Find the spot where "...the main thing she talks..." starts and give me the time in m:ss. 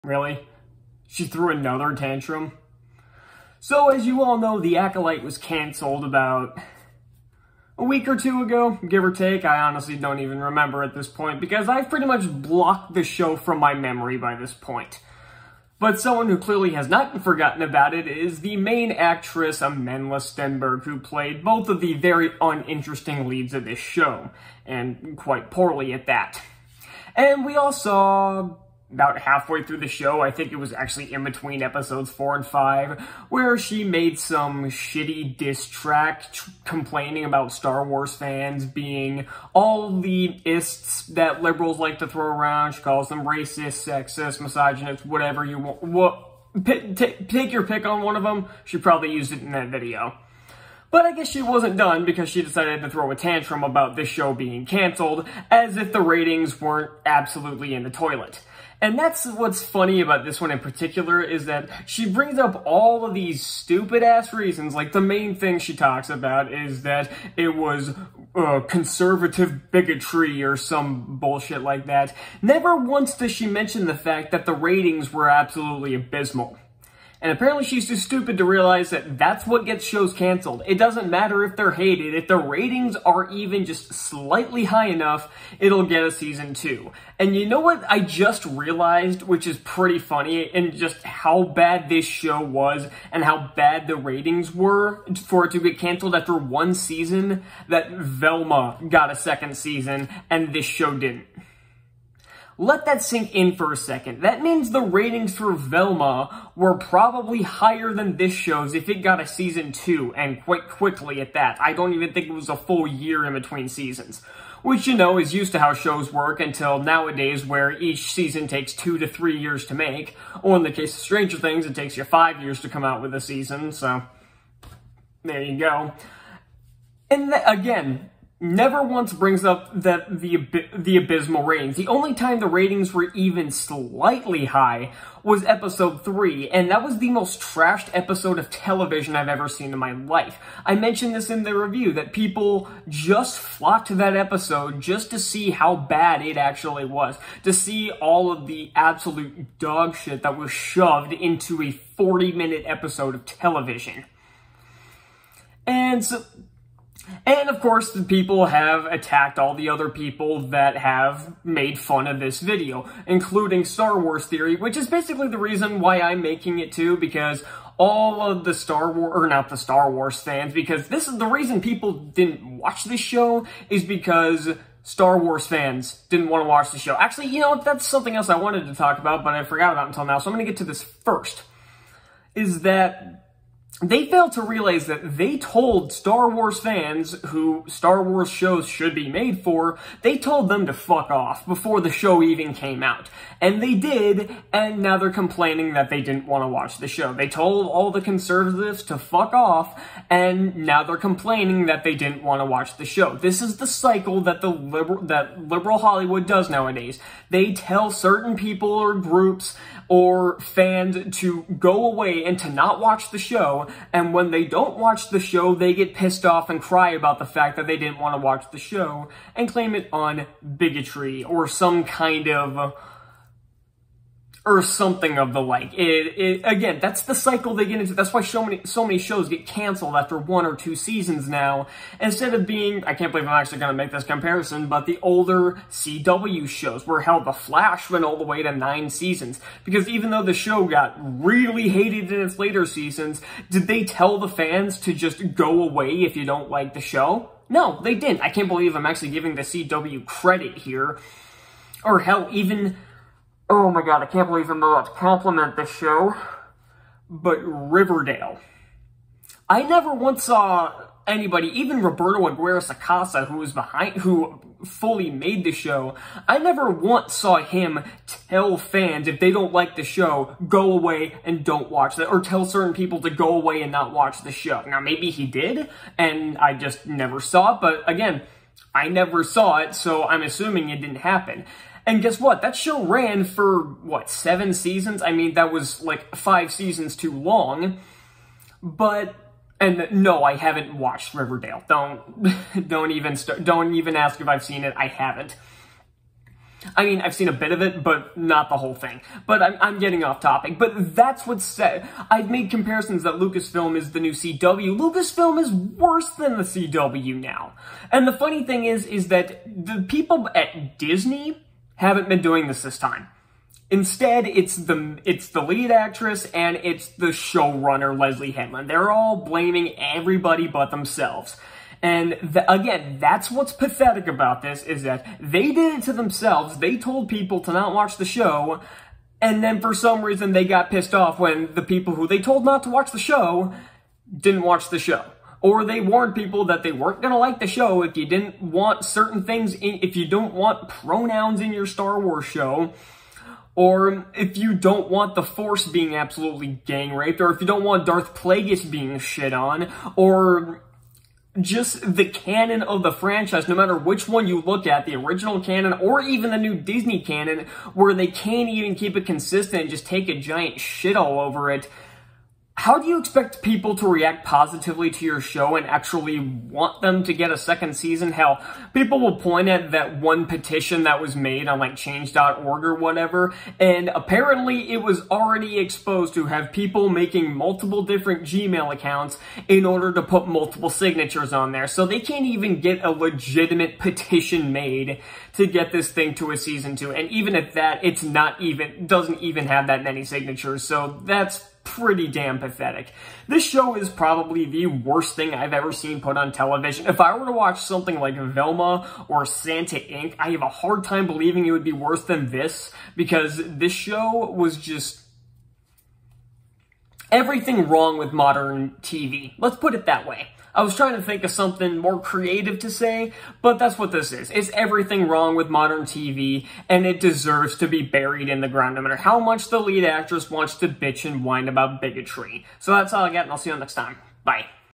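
1:04.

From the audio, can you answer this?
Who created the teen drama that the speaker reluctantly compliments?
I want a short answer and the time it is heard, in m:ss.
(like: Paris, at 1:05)
Roberto Aguirre Sacasa, at 4:21.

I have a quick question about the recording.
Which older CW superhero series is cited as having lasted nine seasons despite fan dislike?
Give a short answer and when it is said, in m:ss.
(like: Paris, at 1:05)
The Flash, at 3:57.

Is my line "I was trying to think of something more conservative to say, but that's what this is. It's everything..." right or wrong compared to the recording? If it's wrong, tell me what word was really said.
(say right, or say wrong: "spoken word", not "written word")
wrong: "creative", not "conservative".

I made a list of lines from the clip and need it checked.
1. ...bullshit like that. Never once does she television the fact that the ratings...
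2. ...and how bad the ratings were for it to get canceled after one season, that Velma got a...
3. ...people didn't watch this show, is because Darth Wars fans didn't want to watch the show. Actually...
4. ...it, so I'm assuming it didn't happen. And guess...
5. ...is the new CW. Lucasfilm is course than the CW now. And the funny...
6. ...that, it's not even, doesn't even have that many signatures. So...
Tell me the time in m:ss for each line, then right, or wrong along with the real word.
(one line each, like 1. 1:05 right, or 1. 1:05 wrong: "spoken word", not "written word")
1. 1:11 wrong: "mention", not "television"
2. 1:33 right
3. 2:51 wrong: "Star", not "Darth"
4. 4:39 right
5. 5:03 wrong: "worse", not "course"
6. 6:27 right.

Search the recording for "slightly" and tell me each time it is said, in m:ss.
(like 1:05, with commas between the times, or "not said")
1:23, 2:13.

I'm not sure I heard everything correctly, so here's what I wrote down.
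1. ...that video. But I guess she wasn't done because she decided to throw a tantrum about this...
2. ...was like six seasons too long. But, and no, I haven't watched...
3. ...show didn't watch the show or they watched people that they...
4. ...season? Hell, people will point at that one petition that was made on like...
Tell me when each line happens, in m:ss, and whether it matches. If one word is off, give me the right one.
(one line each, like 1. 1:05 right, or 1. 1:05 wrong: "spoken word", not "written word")
1. 0:49 right
2. 4:45 wrong: "five", not "six"
3. 5:32 wrong: "warned", not "watched"
4. 6:07 right.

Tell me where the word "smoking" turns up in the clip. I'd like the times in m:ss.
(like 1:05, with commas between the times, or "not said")
not said.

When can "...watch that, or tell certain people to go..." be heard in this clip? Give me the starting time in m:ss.
4:31.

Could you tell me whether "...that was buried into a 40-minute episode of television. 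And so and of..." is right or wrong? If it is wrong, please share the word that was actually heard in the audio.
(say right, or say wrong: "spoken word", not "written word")
wrong: "shoved", not "buried".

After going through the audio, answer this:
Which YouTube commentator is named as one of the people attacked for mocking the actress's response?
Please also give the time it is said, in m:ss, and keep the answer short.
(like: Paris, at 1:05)
Star Wars Theory, at 2:43.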